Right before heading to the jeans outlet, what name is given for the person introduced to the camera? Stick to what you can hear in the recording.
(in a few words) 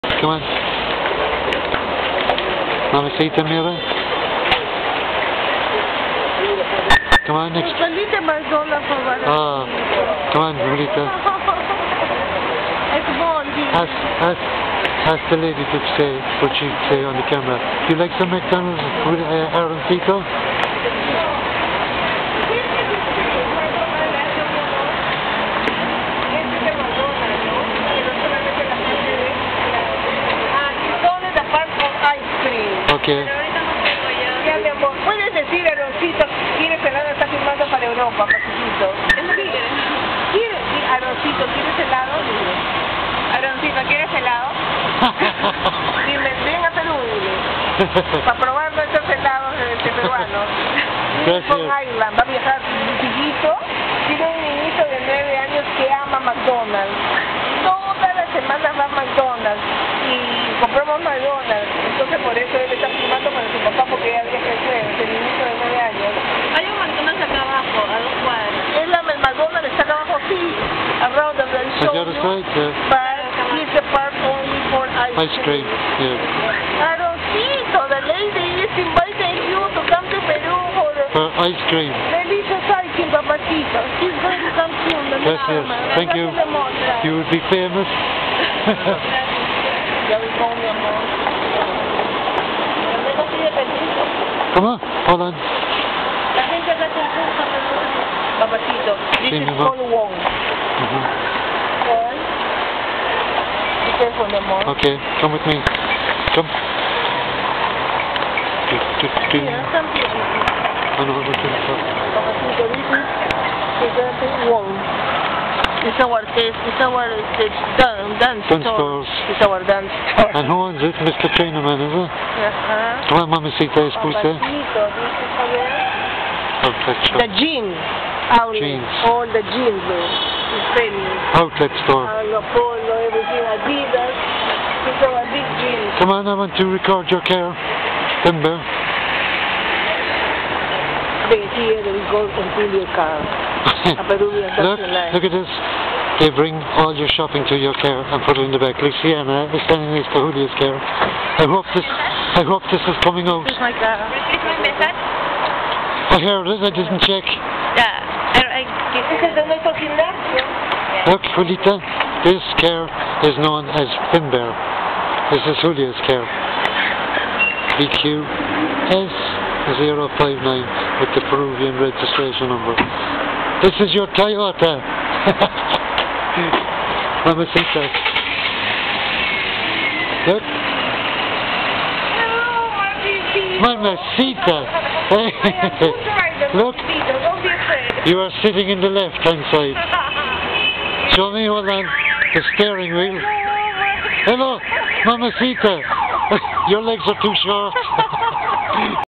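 Paul Wong.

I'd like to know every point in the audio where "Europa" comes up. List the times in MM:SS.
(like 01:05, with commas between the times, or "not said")
00:37.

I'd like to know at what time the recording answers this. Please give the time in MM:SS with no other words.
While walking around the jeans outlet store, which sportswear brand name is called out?
02:13.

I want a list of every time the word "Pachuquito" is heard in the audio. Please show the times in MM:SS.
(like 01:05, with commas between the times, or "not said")
00:38.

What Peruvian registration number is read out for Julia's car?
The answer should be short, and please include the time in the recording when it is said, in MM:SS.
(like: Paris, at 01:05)
BQS059, at 02:47.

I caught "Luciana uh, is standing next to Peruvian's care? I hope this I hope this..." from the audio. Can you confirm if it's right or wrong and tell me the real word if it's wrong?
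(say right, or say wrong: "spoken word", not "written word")
wrong: "Julio", not "Peruvian".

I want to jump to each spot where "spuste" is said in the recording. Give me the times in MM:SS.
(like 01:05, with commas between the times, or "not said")
02:04.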